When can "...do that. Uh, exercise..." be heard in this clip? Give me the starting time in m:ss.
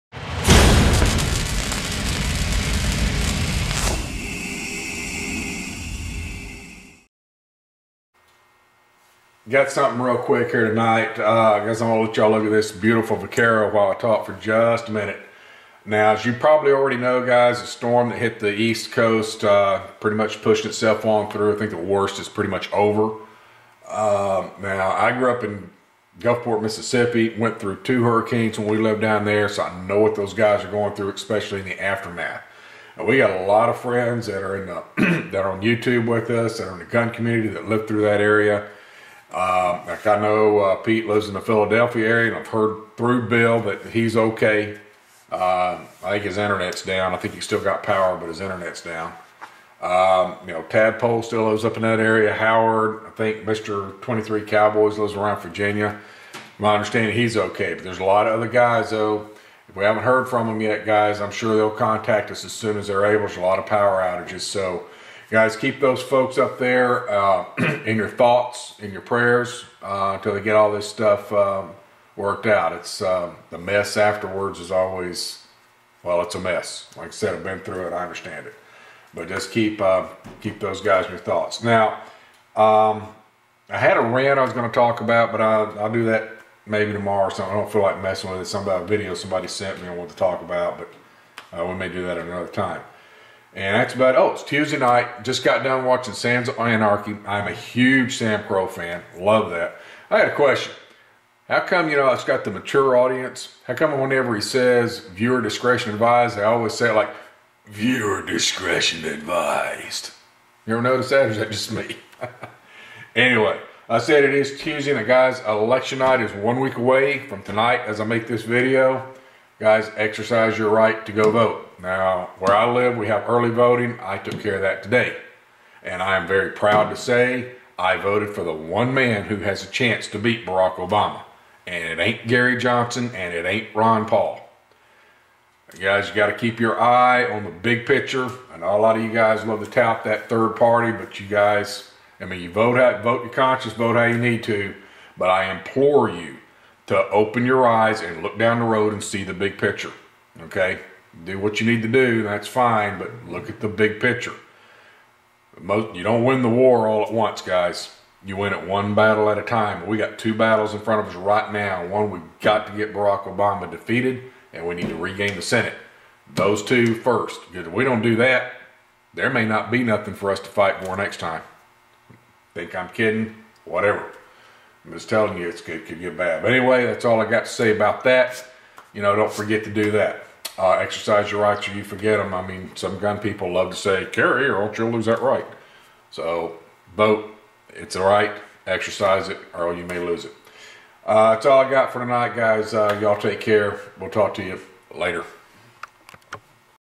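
2:59.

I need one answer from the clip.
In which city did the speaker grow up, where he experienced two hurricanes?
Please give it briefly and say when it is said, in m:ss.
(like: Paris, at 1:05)
Gulfport, Mississippi, at 0:26.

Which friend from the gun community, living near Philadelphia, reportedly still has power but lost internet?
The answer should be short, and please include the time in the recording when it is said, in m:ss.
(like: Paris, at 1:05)
Pete, at 0:40.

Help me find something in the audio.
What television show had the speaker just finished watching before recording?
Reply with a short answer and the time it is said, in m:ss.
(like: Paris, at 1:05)
Sons of Anarchy, at 1:36.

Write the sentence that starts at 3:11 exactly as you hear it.
Uh, that's all I got for tonight, guys.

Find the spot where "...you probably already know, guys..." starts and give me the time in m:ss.
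0:16.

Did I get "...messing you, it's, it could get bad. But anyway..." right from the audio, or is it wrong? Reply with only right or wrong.
wrong.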